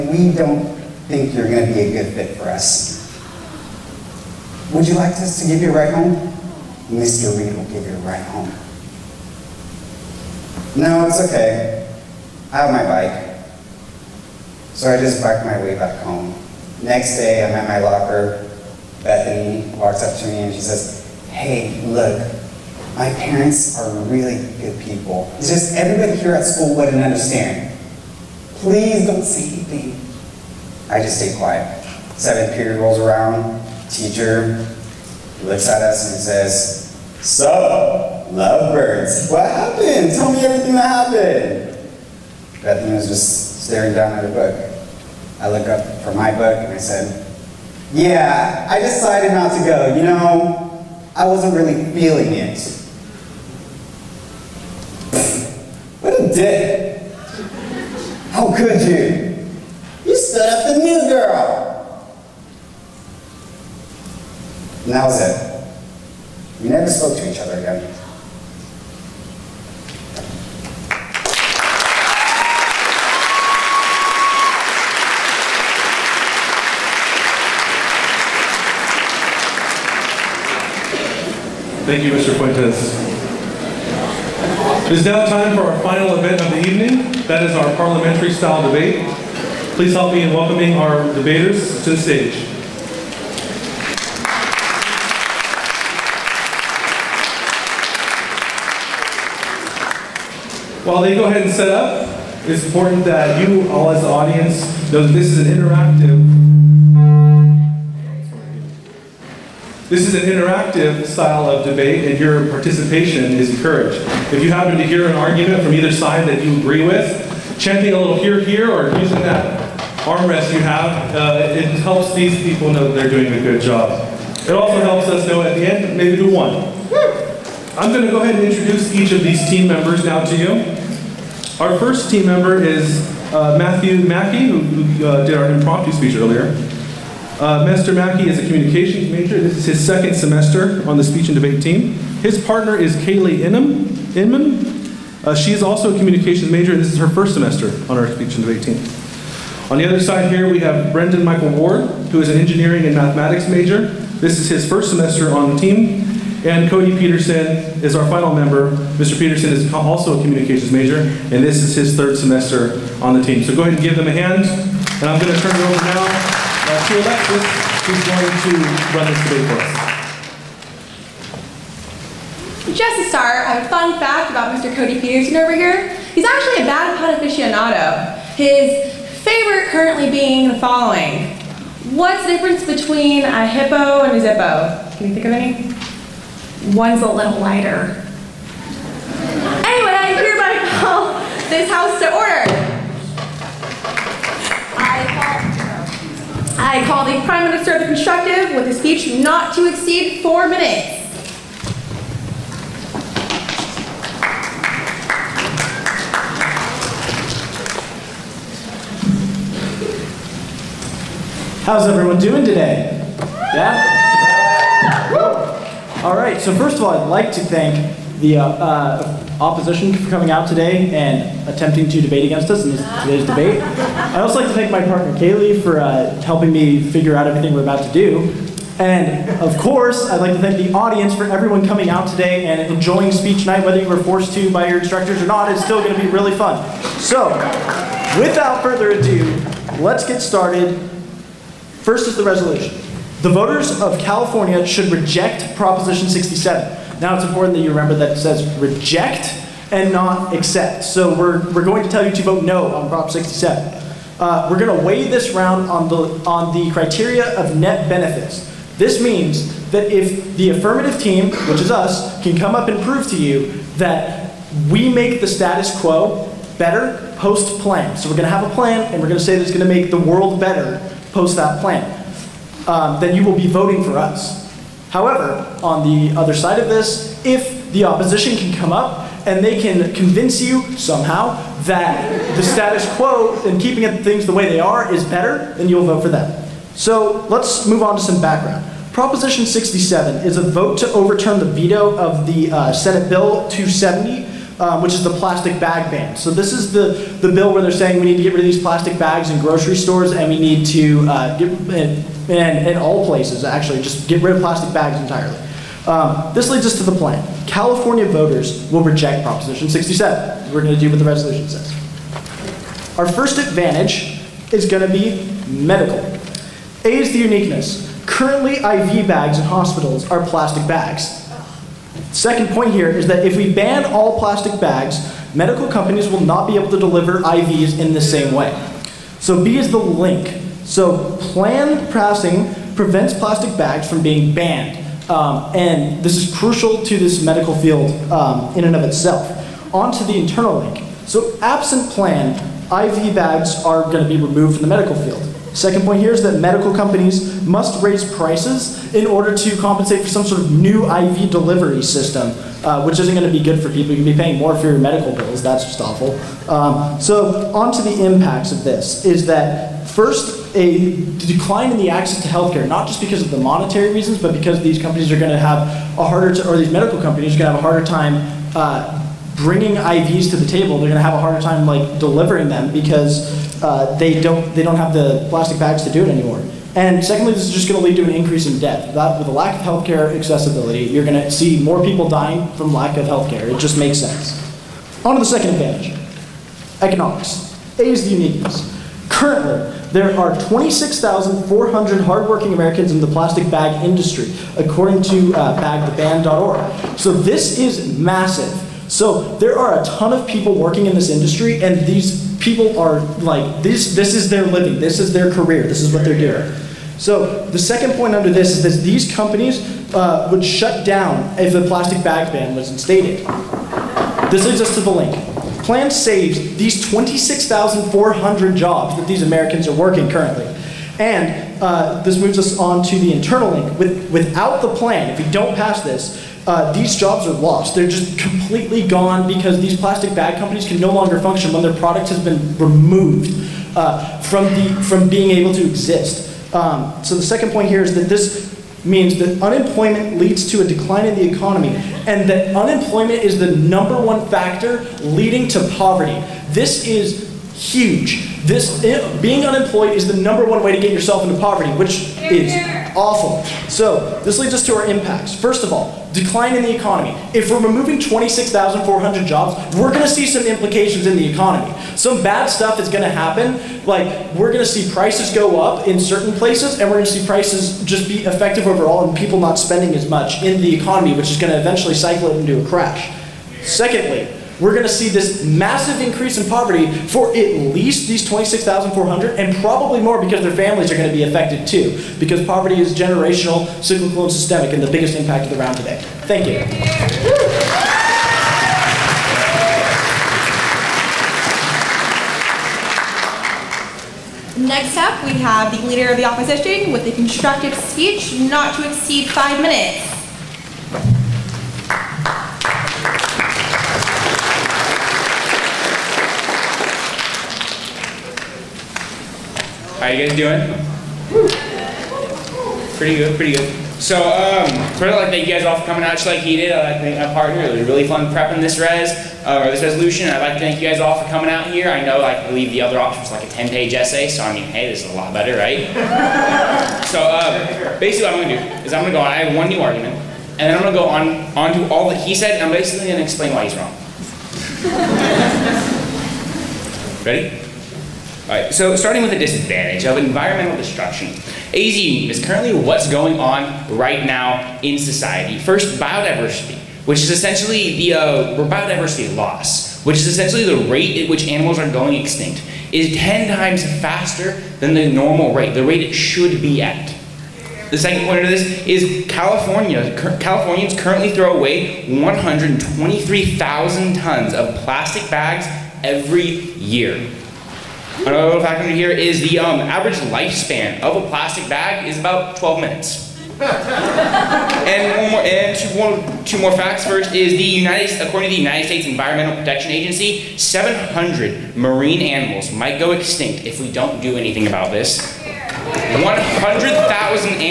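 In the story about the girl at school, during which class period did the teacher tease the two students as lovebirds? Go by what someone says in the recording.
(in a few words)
Seventh period.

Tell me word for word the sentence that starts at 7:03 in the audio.
With, without the plan, if we don't pass this, uh, these jobs are lost.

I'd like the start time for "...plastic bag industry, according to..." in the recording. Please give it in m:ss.
6:33.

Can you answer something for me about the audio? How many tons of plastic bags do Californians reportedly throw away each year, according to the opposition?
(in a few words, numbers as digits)
123,000 tons.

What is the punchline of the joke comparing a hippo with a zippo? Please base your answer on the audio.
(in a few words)
One's a little lighter.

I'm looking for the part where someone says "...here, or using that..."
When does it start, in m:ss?
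1:58.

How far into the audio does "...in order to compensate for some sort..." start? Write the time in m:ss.
5:48.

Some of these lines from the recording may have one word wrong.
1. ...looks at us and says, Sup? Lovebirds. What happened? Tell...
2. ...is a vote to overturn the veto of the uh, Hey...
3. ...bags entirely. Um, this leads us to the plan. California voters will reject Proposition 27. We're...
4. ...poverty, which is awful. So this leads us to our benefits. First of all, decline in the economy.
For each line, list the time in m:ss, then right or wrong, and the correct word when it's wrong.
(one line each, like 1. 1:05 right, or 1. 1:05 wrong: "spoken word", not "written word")
1. 0:35 right
2. 4:50 wrong: "Senate", not "Hey"
3. 5:04 wrong: "67", not "27"
4. 7:31 wrong: "impacts", not "benefits".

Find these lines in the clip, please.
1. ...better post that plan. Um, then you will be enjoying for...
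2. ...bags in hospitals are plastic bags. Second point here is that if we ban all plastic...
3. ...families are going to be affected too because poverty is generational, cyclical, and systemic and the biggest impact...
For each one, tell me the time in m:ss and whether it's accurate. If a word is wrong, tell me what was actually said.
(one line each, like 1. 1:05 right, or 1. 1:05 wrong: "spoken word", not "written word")
1. 4:30 wrong: "voting", not "enjoying"
2. 5:19 right
3. 8:00 right.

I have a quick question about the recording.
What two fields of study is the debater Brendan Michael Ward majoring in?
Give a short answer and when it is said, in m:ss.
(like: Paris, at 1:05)
Engineering and mathematics, at 2:32.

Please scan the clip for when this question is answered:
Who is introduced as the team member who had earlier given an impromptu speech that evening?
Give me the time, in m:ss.
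2:13.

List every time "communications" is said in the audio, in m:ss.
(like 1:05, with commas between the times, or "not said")
2:18, 2:25, 2:40.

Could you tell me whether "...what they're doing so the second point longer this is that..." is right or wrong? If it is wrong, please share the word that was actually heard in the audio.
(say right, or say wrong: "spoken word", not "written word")
wrong: "under", not "longer".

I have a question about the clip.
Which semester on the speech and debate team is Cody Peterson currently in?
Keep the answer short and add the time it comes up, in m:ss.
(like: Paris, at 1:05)
Third, at 2:41.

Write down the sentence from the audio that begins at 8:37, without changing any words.
It was really fun prepping this res, uh, or this resolution.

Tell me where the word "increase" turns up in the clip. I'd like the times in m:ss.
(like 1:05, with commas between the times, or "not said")
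6:18, 7:56.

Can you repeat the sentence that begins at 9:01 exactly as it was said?
AZ is currently what's going on right now in society.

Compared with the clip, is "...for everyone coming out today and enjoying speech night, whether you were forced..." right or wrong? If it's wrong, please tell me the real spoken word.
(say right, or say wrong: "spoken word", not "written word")
right.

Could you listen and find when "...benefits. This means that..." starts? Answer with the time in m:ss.
4:17.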